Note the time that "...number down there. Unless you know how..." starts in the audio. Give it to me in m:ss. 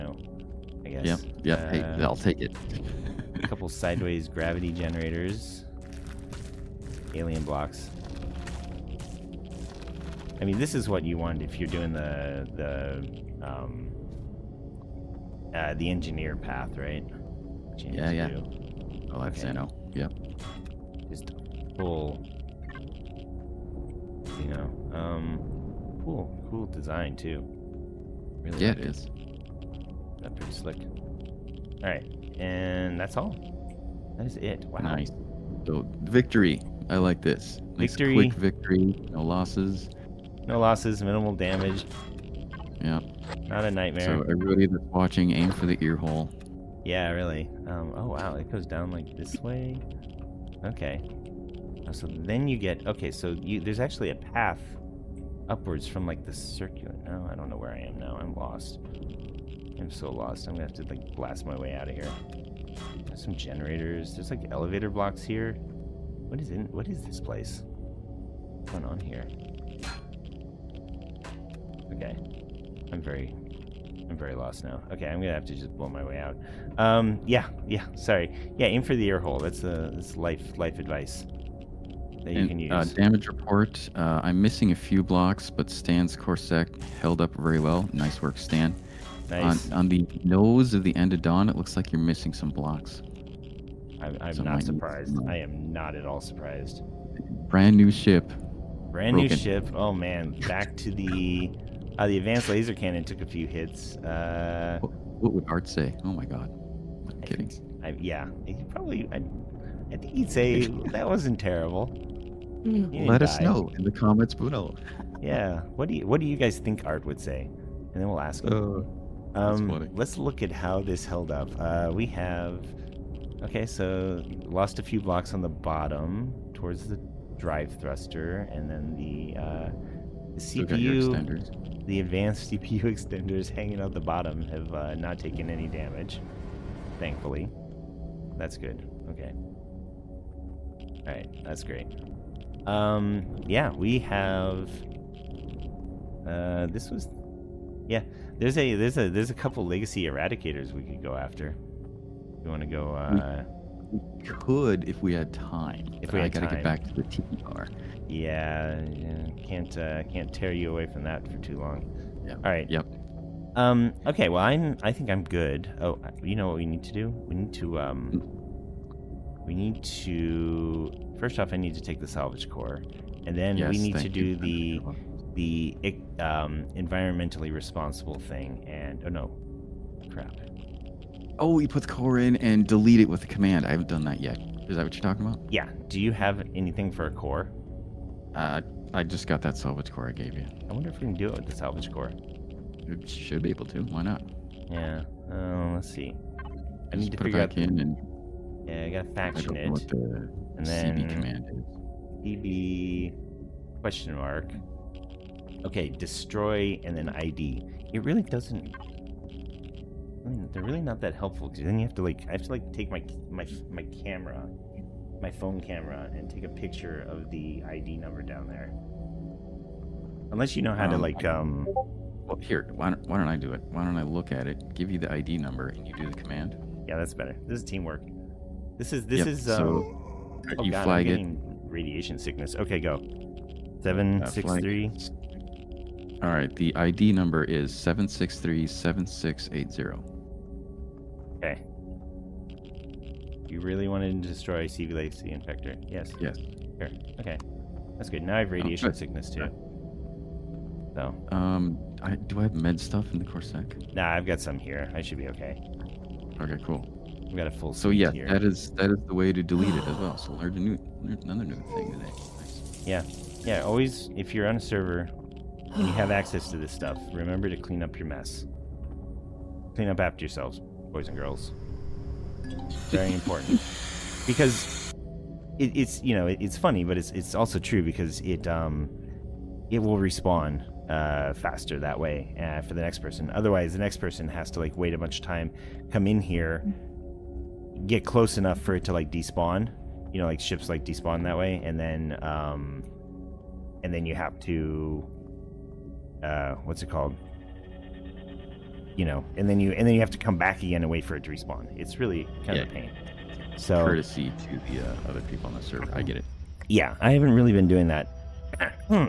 3:37.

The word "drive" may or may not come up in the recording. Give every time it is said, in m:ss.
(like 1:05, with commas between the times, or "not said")
2:07.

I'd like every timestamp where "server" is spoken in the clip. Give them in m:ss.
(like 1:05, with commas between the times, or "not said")
4:24, 5:05.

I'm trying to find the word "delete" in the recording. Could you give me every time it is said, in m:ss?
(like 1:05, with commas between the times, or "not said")
3:02, 4:19.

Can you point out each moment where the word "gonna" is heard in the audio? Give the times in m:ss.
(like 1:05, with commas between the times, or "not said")
1:00, 1:15.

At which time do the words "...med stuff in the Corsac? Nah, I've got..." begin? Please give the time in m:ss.
4:12.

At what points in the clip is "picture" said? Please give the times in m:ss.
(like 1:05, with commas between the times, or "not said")
3:36.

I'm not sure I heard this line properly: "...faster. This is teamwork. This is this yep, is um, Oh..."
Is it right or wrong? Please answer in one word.
wrong.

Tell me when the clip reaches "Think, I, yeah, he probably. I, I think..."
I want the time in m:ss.
1:47.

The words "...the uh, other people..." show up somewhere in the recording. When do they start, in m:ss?
5:04.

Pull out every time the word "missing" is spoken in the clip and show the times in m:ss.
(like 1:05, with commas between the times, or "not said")
1:24, 1:32.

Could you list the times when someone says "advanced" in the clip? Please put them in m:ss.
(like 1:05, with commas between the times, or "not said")
1:42, 2:11.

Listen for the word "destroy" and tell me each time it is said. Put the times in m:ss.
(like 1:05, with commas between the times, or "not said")
3:25, 4:04.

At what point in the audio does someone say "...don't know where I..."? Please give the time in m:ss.
0:57.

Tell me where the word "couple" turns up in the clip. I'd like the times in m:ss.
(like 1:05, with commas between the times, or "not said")
0:03, 2:29.